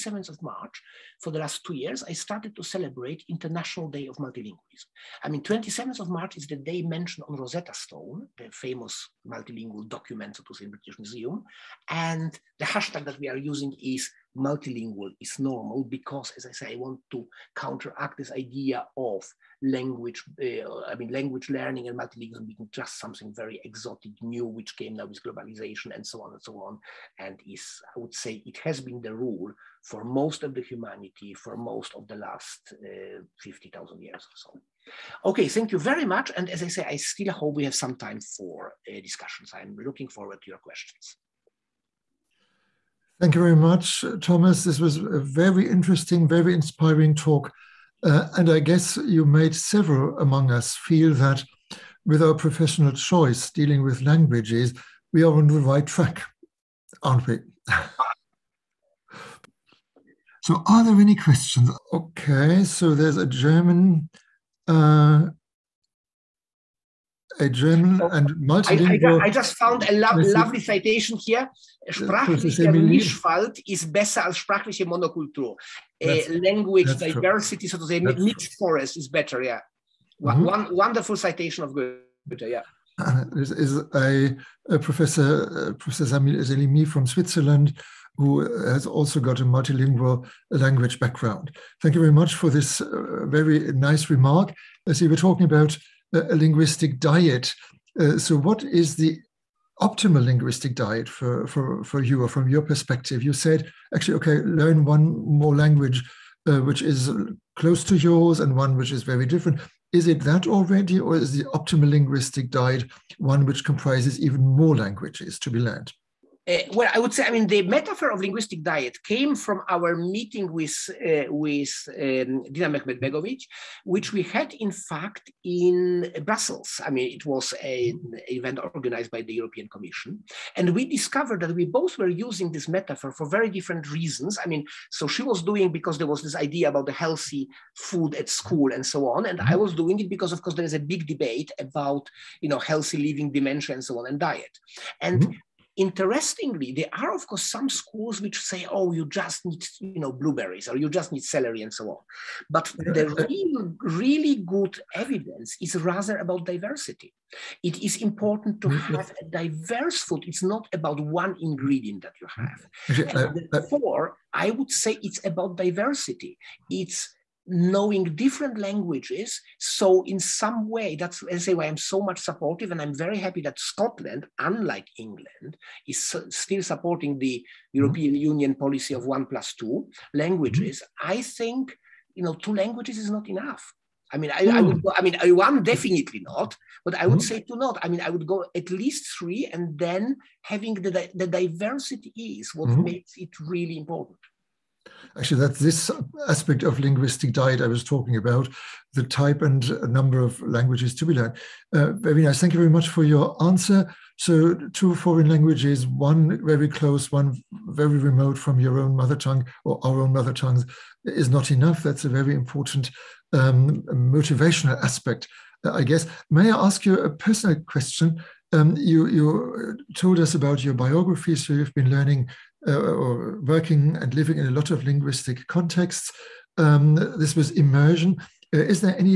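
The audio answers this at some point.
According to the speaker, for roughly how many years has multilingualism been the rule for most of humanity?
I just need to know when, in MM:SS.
00:33.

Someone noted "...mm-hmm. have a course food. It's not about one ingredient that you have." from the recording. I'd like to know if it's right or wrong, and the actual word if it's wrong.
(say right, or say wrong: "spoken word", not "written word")
wrong: "diverse", not "course".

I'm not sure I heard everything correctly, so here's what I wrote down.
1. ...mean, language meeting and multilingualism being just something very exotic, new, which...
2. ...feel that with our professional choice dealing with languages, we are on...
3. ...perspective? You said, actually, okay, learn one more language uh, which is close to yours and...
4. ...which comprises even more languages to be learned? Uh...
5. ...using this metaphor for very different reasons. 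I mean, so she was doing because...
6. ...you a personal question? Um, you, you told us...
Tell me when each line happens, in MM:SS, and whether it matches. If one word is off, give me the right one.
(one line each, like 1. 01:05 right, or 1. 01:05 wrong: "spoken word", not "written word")
1. 00:20 wrong: "learning", not "meeting"
2. 00:50 right
3. 01:42 right
4. 01:53 right
5. 02:12 right
6. 03:36 right.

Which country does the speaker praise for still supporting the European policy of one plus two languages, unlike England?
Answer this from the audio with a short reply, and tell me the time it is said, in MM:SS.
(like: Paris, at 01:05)
Scotland, at 02:53.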